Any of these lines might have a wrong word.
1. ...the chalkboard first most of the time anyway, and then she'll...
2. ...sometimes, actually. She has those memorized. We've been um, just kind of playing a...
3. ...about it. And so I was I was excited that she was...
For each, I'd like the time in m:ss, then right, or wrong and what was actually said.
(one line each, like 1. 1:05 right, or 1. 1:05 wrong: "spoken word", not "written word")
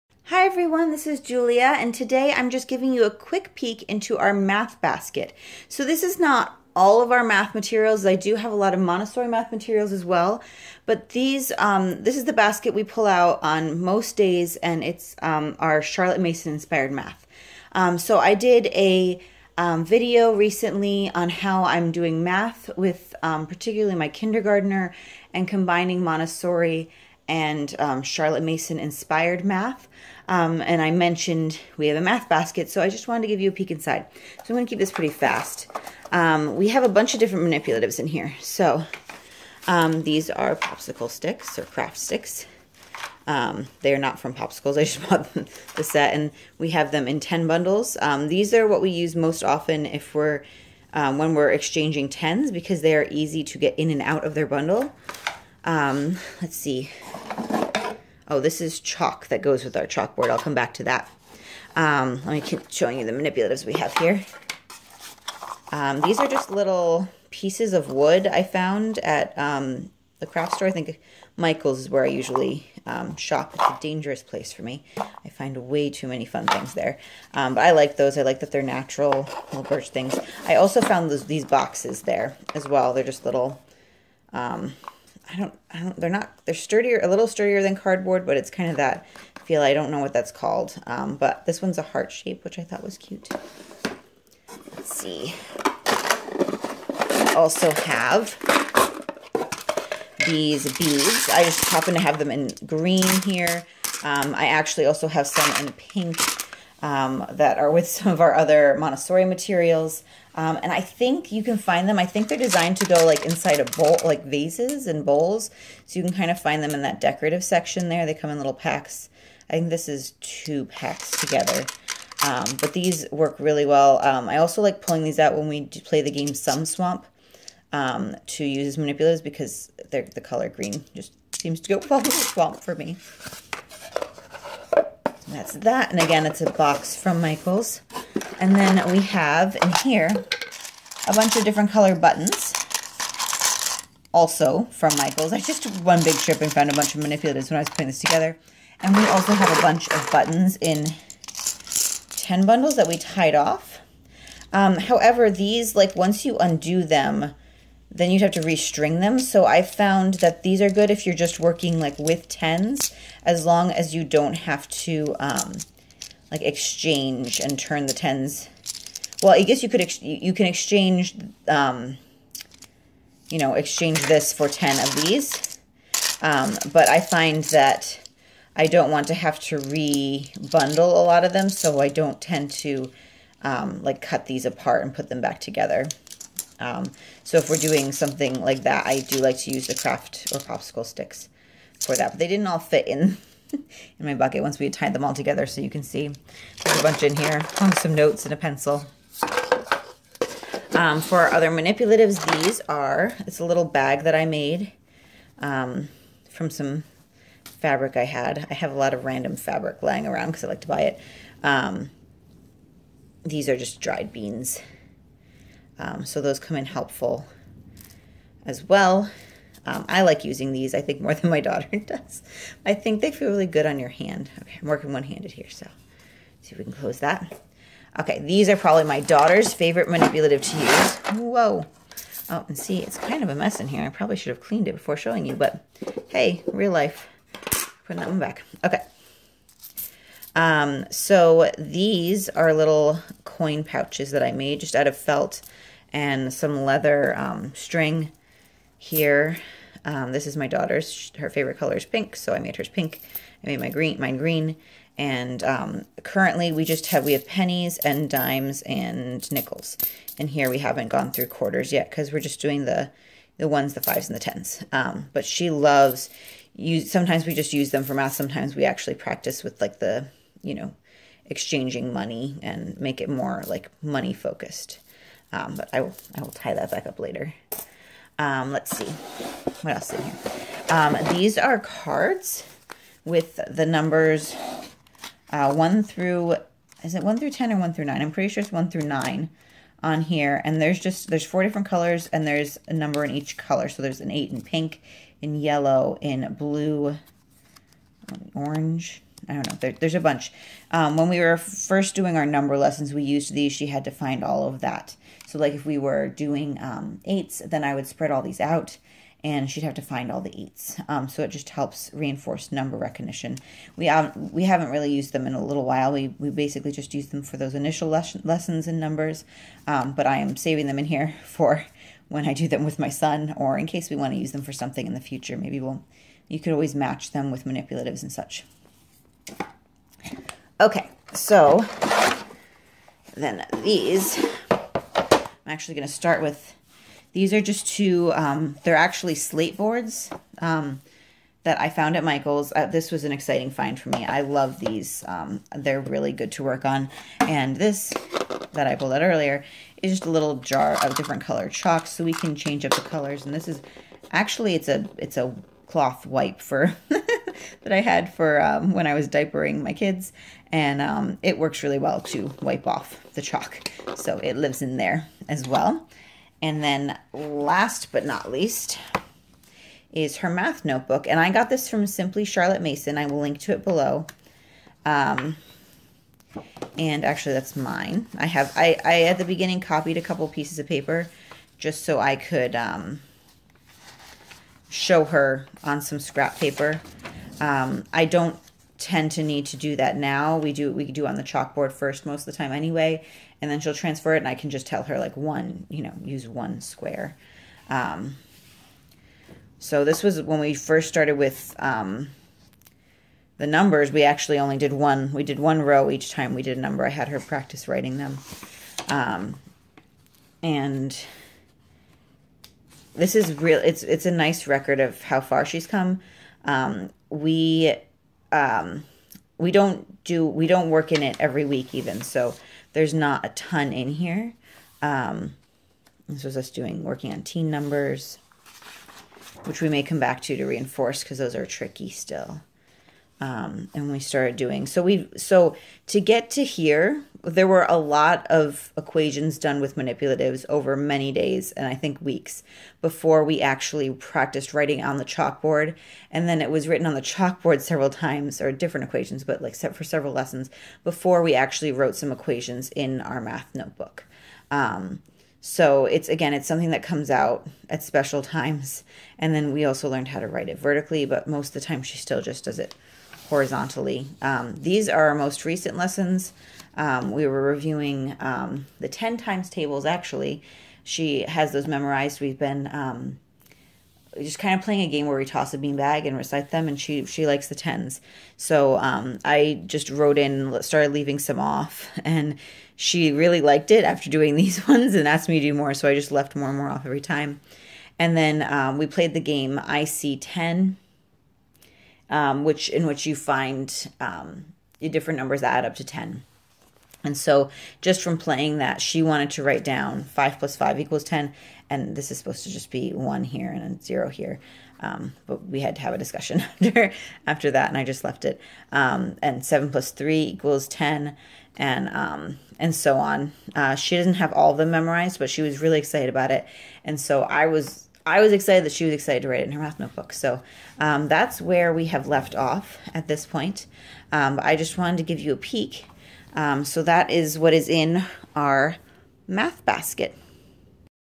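1. 6:31 right
2. 7:49 wrong: "tables", not "sometimes"
3. 8:36 right.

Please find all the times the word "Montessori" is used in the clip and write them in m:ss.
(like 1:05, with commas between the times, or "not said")
0:08, 0:26, 1:48.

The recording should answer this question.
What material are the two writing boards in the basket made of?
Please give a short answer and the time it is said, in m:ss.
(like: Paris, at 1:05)
slate, at 5:39.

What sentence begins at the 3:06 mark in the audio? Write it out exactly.
Um, so if we're doing something like that, I do like to use the craft or popsicle sticks for that.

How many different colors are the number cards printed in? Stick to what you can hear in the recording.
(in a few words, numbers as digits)
4.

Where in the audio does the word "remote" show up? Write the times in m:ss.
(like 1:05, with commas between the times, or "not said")
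not said.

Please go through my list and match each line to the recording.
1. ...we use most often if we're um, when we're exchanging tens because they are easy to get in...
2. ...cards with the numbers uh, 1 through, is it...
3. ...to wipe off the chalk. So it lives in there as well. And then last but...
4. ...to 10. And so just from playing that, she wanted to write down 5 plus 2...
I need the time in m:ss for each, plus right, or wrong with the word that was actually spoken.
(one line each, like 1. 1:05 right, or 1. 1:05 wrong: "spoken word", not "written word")
1. 0:48 right
2. 4:41 right
3. 6:02 right
4. 8:15 wrong: "5", not "2".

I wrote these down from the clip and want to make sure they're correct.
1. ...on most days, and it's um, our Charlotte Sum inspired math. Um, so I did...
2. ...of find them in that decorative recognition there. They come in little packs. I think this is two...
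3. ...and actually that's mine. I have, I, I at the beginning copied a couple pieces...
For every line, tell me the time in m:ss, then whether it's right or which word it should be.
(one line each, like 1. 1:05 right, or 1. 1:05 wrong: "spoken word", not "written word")
1. 0:13 wrong: "Mason", not "Sum"
2. 1:56 wrong: "section", not "recognition"
3. 6:16 right.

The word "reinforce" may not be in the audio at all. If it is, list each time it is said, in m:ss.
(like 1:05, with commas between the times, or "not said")
5:11, 7:10.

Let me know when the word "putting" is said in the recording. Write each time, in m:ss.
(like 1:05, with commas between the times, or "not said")
2:27, 3:57.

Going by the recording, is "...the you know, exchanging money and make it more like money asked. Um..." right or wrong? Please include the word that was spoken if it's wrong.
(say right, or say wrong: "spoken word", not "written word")
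wrong: "focused", not "asked".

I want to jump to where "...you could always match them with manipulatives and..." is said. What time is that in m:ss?
5:26.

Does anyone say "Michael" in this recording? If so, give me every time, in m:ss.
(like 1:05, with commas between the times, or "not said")
1:11, 2:17, 2:24, 5:42.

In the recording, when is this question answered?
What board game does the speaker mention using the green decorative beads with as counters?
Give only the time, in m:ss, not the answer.
2:06.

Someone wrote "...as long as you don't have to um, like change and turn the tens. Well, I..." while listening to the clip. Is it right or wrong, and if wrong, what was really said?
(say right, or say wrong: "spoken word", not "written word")
wrong: "exchange", not "change".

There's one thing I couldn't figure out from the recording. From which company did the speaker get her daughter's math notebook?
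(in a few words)
Simply Charlotte Mason.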